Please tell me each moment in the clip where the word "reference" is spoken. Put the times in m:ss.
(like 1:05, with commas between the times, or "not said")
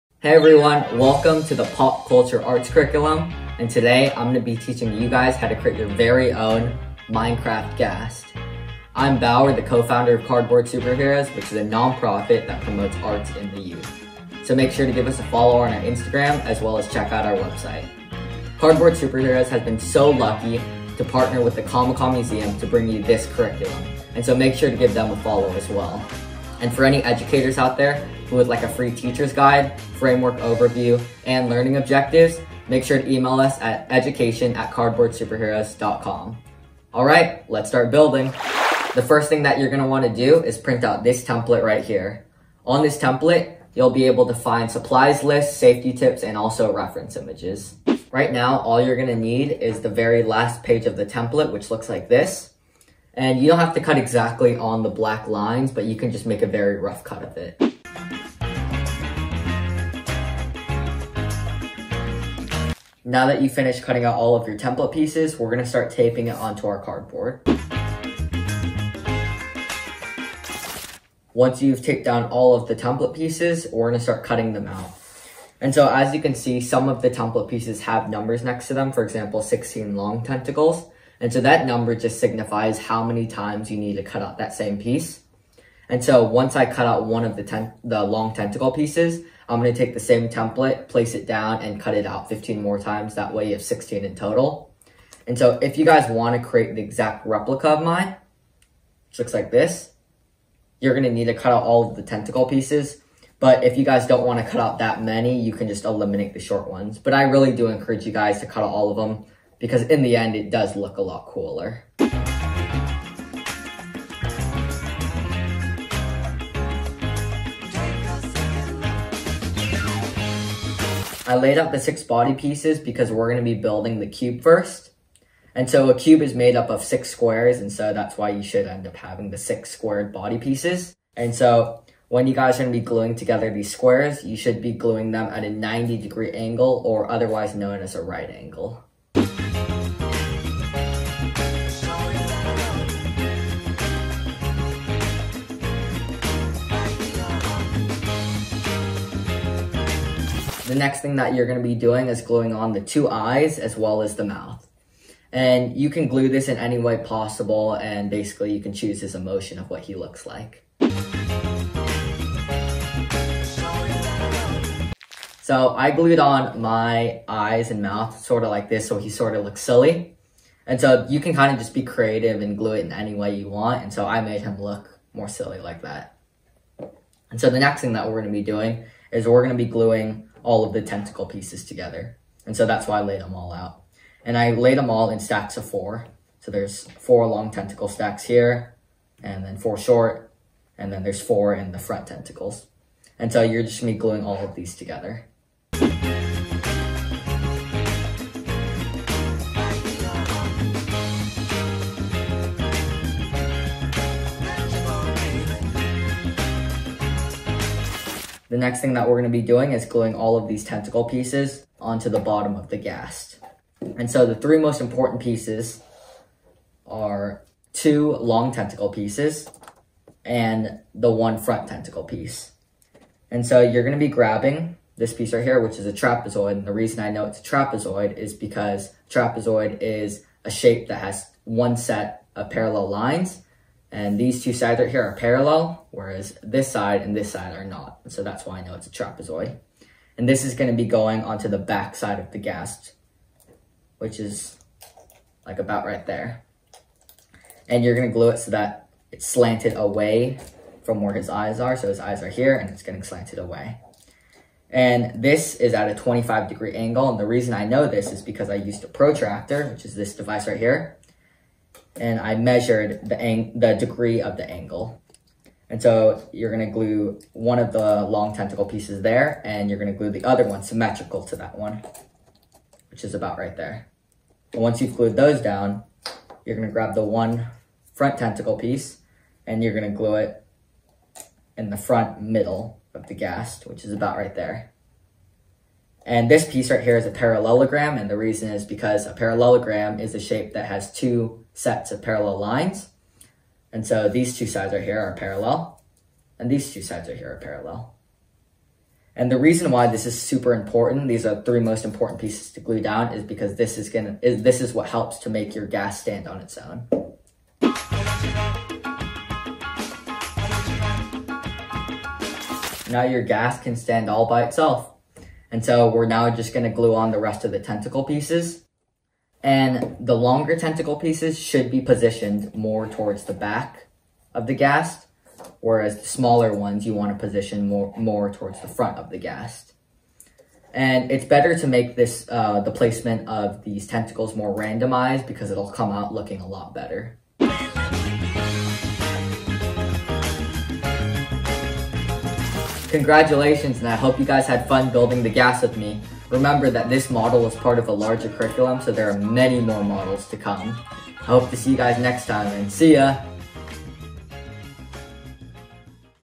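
0:46.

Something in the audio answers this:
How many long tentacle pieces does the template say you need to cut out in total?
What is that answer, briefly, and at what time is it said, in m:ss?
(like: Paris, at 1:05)
16, at 1:19.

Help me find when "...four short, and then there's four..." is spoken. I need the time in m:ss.
3:09.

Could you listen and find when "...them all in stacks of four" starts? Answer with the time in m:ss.
3:04.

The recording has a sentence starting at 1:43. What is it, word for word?
But if you guys don't want to cut out that many, you can just eliminate the short ones.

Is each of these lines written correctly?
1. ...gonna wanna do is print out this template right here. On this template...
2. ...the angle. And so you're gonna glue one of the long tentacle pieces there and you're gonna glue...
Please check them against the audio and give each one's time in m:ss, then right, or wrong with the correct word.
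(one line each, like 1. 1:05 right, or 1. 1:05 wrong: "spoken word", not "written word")
1. 0:39 right
2. 4:24 right.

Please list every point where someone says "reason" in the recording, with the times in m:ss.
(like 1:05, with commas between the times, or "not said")
3:46, 4:17, 4:48, 4:59.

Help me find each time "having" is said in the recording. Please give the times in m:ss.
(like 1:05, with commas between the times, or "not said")
2:08.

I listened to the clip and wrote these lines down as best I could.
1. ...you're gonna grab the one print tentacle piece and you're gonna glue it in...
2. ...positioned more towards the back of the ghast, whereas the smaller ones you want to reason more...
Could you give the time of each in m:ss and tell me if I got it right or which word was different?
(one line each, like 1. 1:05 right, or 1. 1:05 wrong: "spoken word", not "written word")
1. 4:36 wrong: "front", not "print"
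2. 5:21 wrong: "position", not "reason".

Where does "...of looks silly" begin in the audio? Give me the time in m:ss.
2:49.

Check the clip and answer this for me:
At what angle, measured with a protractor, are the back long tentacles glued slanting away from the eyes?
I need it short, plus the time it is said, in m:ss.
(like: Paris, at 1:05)
25 degrees, at 4:15.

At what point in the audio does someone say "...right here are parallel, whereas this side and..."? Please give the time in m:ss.
3:54.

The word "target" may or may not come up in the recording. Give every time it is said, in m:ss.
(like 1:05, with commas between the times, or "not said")
not said.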